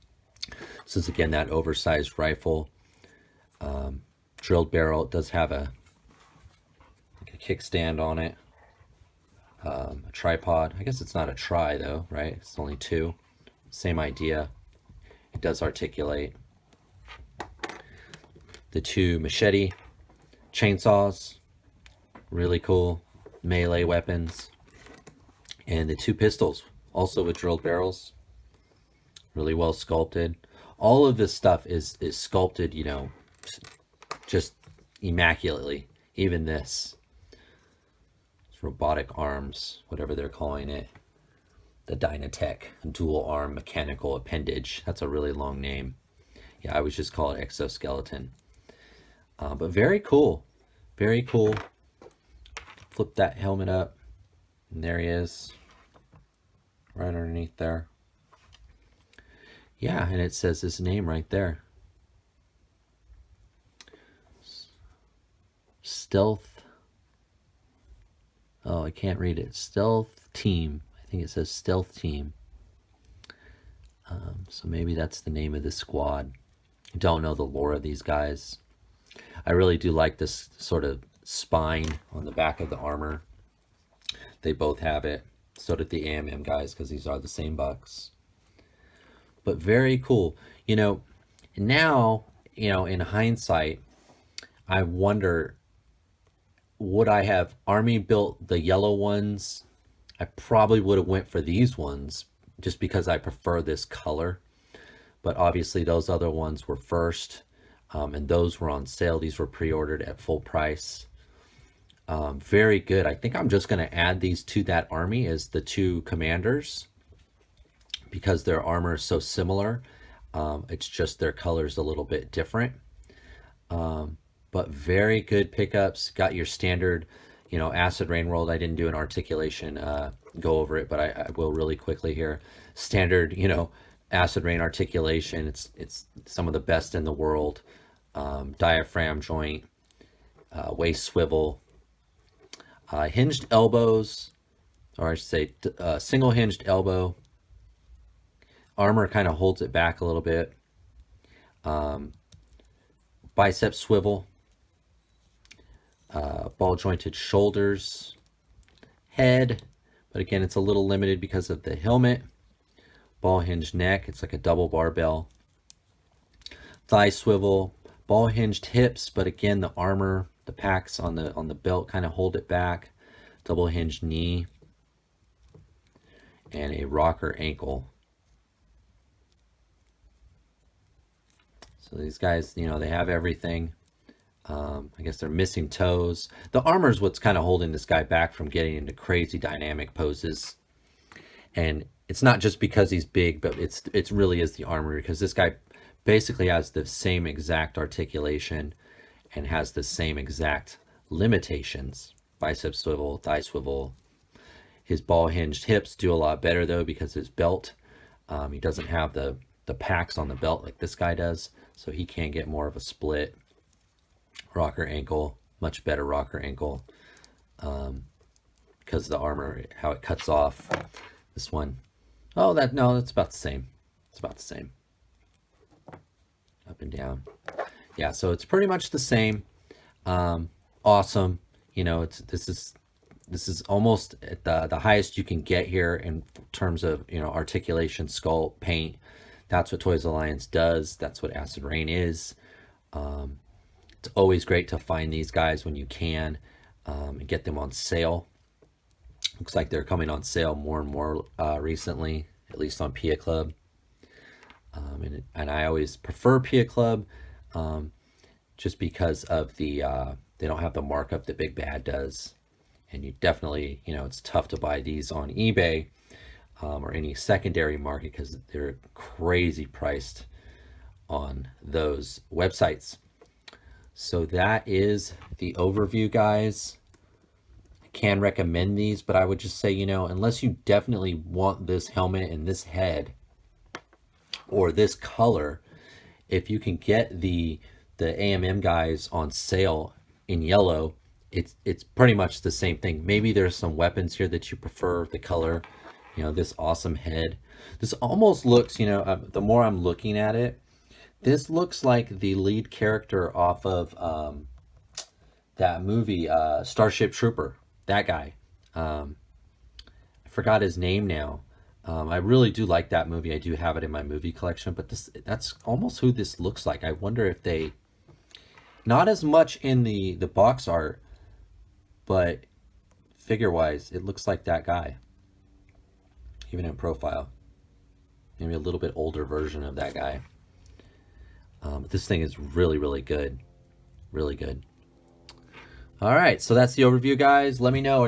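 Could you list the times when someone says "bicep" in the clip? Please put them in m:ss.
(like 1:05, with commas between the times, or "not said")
2:33, 3:22.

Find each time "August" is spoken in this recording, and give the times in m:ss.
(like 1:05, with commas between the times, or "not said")
not said.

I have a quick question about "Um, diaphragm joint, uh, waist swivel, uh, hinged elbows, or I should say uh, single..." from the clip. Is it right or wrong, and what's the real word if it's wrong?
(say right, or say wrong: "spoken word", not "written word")
right.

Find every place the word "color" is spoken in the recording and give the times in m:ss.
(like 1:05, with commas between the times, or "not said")
1:43, 2:01, 4:44, 4:55.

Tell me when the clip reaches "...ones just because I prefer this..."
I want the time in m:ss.
1:41.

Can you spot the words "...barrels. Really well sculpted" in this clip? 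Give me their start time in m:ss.
0:27.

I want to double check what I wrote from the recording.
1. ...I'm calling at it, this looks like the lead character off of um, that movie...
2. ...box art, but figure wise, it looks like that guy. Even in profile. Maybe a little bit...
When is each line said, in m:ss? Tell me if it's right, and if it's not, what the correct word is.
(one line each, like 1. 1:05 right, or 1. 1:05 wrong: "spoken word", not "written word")
1. 4:59 wrong: "looking", not "calling"
2. 5:20 right.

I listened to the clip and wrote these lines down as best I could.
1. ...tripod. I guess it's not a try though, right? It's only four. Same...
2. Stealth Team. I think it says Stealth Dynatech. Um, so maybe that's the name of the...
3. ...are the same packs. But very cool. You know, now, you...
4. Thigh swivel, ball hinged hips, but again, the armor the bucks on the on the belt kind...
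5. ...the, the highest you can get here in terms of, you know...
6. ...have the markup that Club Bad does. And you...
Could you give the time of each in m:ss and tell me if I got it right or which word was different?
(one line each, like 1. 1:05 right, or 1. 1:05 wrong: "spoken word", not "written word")
1. 0:10 wrong: "two", not "four"
2. 1:09 wrong: "Team", not "Dynatech"
3. 1:27 wrong: "bucks", not "packs"
4. 2:46 wrong: "packs", not "bucks"
5. 3:54 right
6. 4:20 wrong: "Big", not "Club".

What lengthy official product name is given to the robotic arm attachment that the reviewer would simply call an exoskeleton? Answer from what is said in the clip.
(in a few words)
Dynatech dual arm mechanical appendage.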